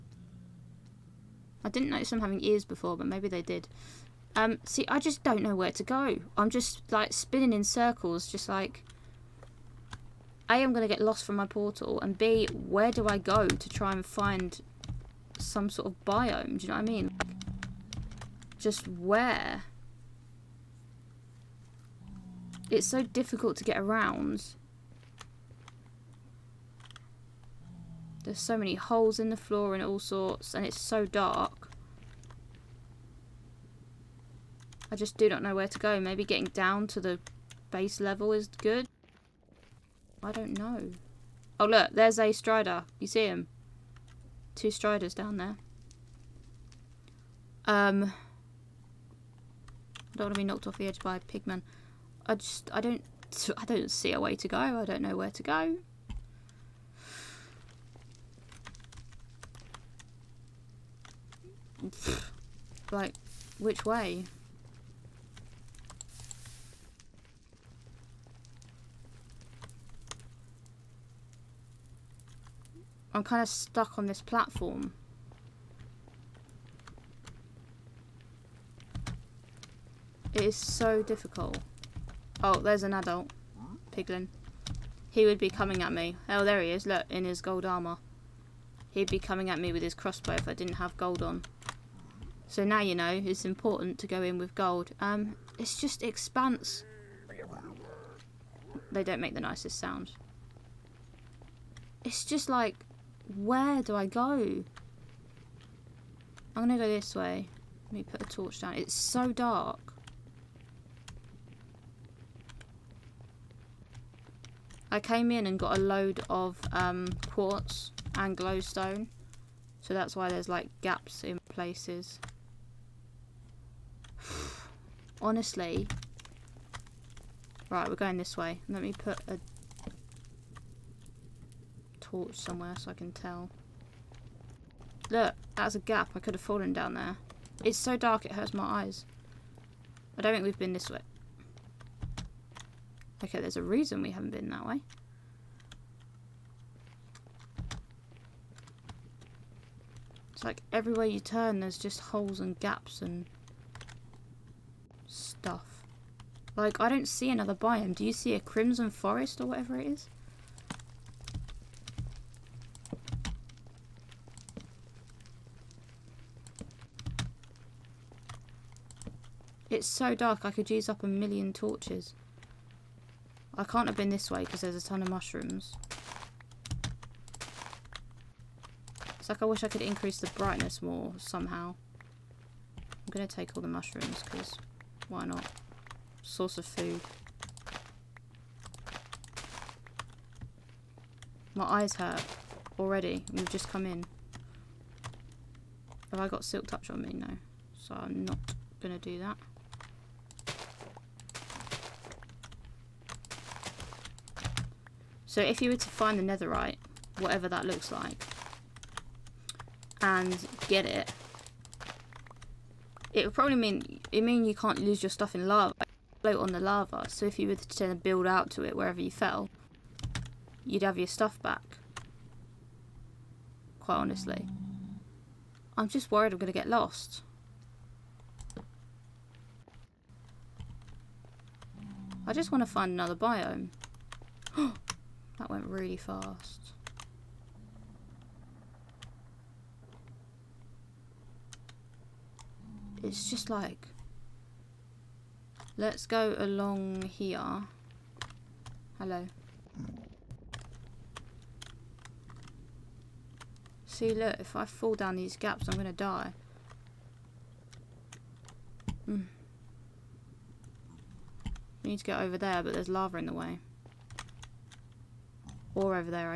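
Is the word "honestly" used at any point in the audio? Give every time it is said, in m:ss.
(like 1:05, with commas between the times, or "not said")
2:05, 3:43.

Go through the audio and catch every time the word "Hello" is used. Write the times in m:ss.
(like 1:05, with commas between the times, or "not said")
4:08.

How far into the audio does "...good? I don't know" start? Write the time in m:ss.
0:38.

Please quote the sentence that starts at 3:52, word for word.
I just want to find another biome.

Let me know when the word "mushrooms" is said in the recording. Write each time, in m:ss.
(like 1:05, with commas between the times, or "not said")
2:55, 3:03.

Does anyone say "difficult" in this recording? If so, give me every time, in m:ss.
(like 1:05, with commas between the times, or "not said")
0:23, 1:21.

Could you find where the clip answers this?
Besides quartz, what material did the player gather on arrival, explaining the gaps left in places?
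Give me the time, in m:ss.
1:58.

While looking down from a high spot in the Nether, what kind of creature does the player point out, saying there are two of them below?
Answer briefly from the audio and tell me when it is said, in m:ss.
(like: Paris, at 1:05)
Striders, at 0:44.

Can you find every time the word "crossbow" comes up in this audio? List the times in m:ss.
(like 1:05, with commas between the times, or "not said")
1:29.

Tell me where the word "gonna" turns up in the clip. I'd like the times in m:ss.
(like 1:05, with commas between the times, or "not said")
1:46, 3:46.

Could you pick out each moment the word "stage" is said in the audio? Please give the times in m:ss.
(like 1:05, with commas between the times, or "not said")
not said.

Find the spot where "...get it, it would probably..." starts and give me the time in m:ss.
3:30.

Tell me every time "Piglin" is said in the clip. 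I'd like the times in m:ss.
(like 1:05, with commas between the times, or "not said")
1:23.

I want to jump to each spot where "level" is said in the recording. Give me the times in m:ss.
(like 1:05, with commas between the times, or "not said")
0:37.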